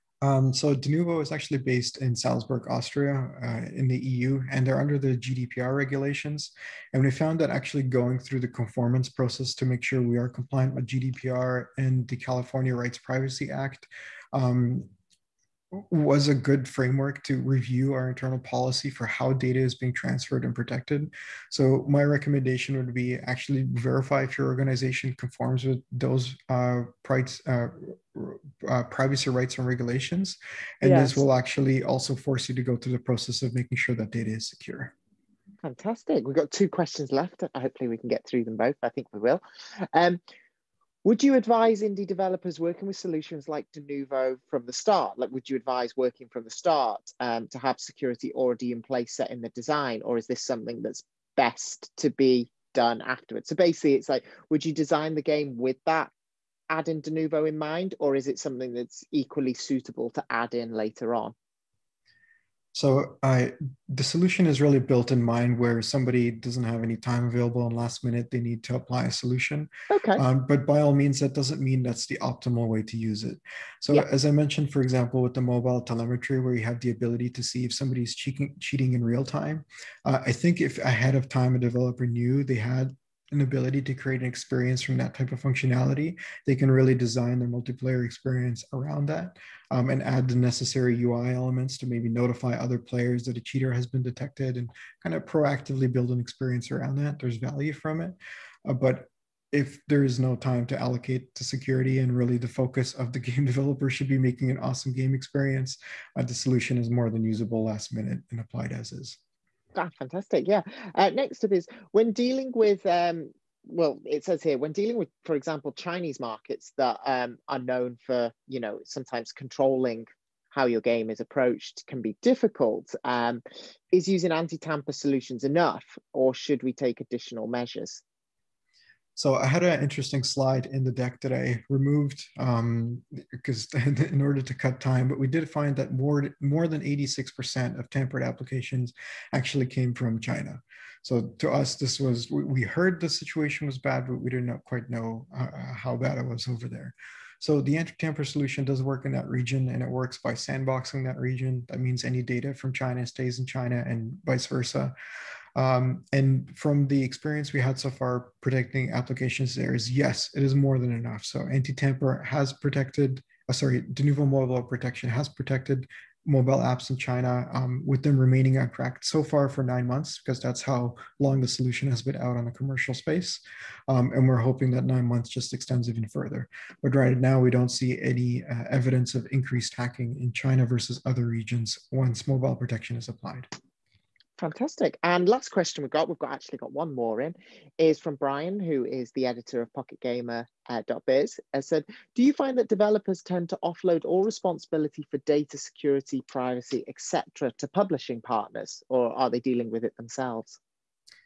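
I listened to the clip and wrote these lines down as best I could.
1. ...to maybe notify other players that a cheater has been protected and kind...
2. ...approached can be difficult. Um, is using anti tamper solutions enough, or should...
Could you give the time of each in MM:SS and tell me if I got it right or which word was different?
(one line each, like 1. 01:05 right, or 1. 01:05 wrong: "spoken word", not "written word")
1. 01:31 wrong: "detected", not "protected"
2. 02:01 right.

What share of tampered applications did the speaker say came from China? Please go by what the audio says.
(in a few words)
86%.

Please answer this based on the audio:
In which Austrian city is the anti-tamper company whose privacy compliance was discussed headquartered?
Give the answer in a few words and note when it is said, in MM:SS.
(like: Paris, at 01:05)
Salzburg, at 00:02.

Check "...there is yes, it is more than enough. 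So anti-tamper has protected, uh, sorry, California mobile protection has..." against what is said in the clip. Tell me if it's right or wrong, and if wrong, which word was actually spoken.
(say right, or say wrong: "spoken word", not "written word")
wrong: "Denuvo", not "California".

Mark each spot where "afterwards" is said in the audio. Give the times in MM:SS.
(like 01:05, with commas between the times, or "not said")
00:53.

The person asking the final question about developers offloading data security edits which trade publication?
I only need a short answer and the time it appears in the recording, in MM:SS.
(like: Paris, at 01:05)
PocketGamer.biz, at 03:09.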